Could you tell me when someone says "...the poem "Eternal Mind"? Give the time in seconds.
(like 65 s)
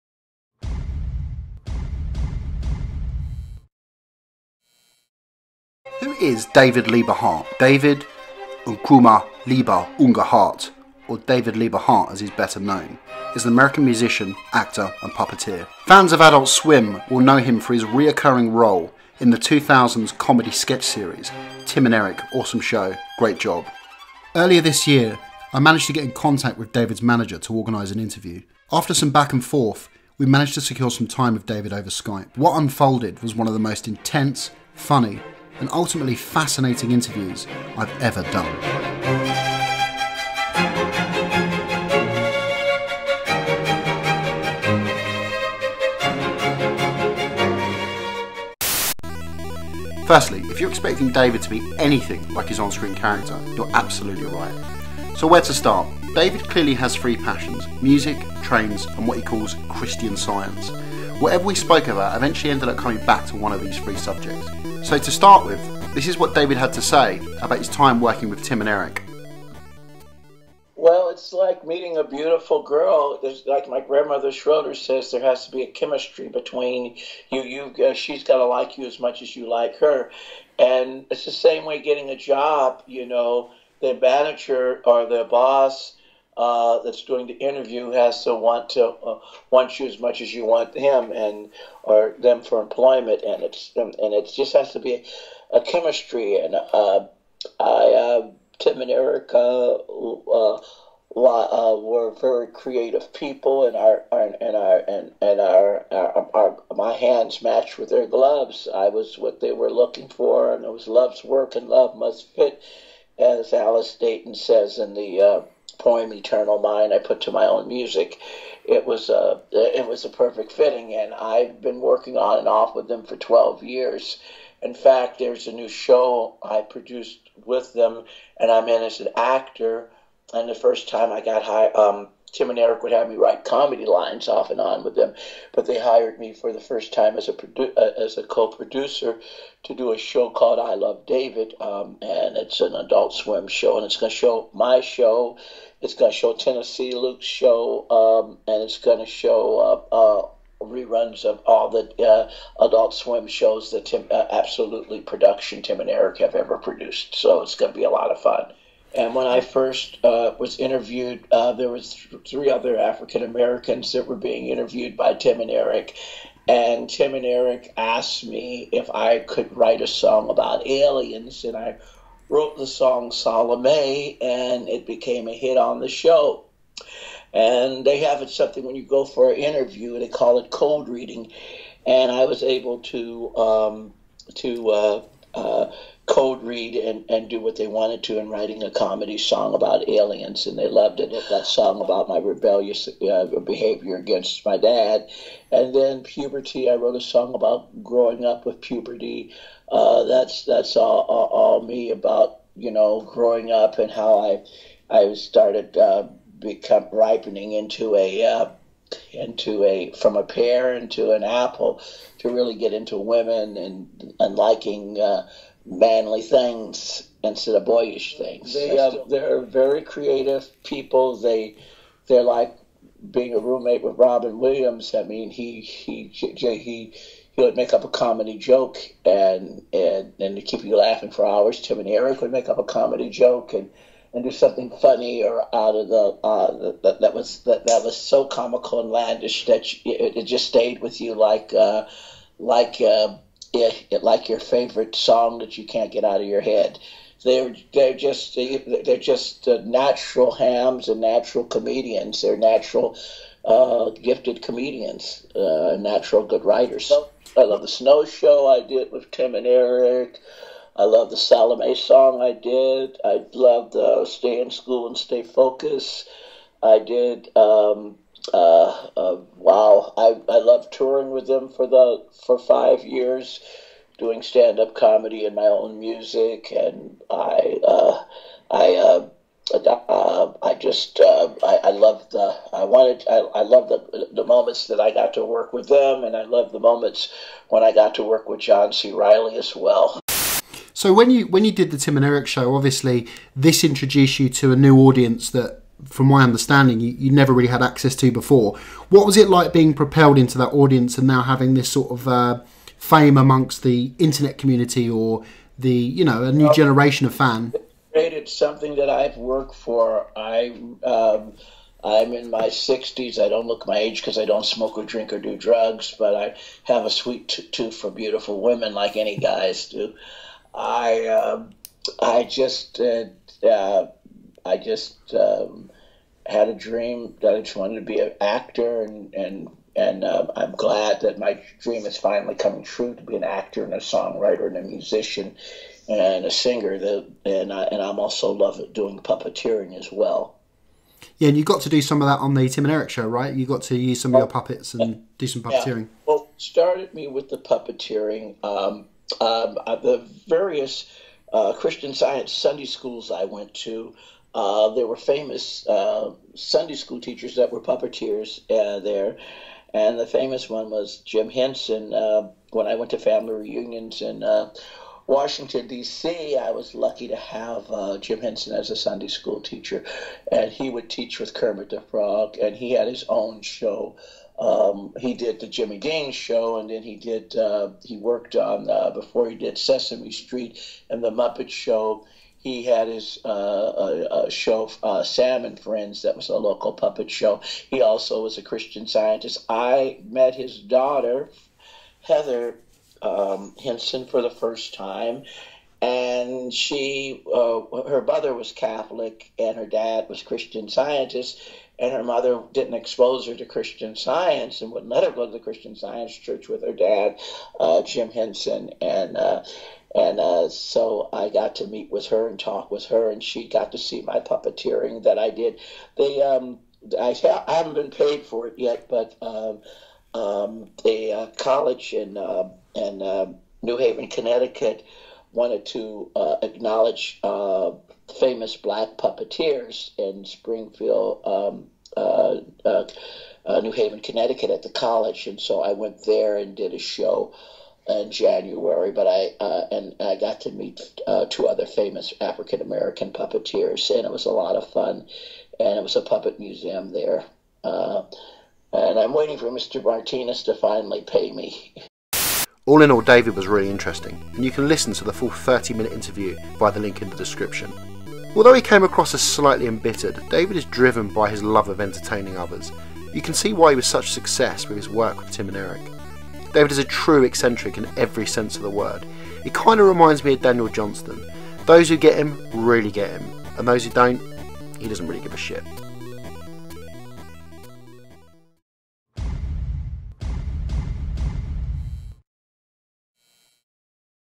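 114 s.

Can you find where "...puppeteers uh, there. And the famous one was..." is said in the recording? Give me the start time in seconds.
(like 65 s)
357 s.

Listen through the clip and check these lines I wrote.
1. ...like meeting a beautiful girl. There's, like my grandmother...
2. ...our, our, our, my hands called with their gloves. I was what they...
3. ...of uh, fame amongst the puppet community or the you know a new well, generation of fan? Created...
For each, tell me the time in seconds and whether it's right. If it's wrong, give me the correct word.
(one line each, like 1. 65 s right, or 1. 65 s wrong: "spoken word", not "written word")
1. 71 s right
2. 105 s wrong: "matched", not "called"
3. 301 s wrong: "internet", not "puppet".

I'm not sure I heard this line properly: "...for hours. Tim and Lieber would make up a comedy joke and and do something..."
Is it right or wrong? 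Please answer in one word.
wrong.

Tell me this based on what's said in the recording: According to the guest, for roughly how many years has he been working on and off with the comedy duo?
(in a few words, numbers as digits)
12.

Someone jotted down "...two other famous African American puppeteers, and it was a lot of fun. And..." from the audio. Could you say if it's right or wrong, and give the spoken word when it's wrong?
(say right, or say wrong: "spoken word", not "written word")
right.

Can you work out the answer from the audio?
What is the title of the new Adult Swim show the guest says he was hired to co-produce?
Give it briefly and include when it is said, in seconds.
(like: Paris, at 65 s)
I Love David, at 140 s.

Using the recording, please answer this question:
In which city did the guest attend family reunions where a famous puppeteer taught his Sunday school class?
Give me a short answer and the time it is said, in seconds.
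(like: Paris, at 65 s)
Washington, D.C., at 365 s.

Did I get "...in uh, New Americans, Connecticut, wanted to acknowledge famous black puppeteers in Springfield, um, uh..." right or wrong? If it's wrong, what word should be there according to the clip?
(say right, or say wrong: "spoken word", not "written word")
wrong: "Haven", not "Americans".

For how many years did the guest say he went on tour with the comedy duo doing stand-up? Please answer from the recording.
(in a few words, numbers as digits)
5.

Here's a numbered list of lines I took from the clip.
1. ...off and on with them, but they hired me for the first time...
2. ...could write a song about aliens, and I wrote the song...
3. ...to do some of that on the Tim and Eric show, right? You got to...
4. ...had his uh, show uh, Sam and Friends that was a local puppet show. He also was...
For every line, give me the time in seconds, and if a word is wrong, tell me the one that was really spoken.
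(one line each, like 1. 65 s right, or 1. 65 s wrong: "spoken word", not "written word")
1. 134 s right
2. 169 s right
3. 341 s right
4. 382 s right.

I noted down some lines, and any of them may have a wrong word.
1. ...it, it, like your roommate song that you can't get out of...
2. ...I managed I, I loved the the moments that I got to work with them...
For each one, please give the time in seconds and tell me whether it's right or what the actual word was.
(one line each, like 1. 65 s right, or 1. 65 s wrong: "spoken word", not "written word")
1. 243 s wrong: "favorite", not "roommate"
2. 282 s wrong: "wanted", not "managed".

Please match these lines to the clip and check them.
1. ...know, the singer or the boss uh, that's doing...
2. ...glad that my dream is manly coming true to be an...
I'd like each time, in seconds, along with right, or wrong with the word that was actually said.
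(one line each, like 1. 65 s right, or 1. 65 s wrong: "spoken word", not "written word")
1. 83 s wrong: "manager", not "singer"
2. 330 s wrong: "finally", not "manly".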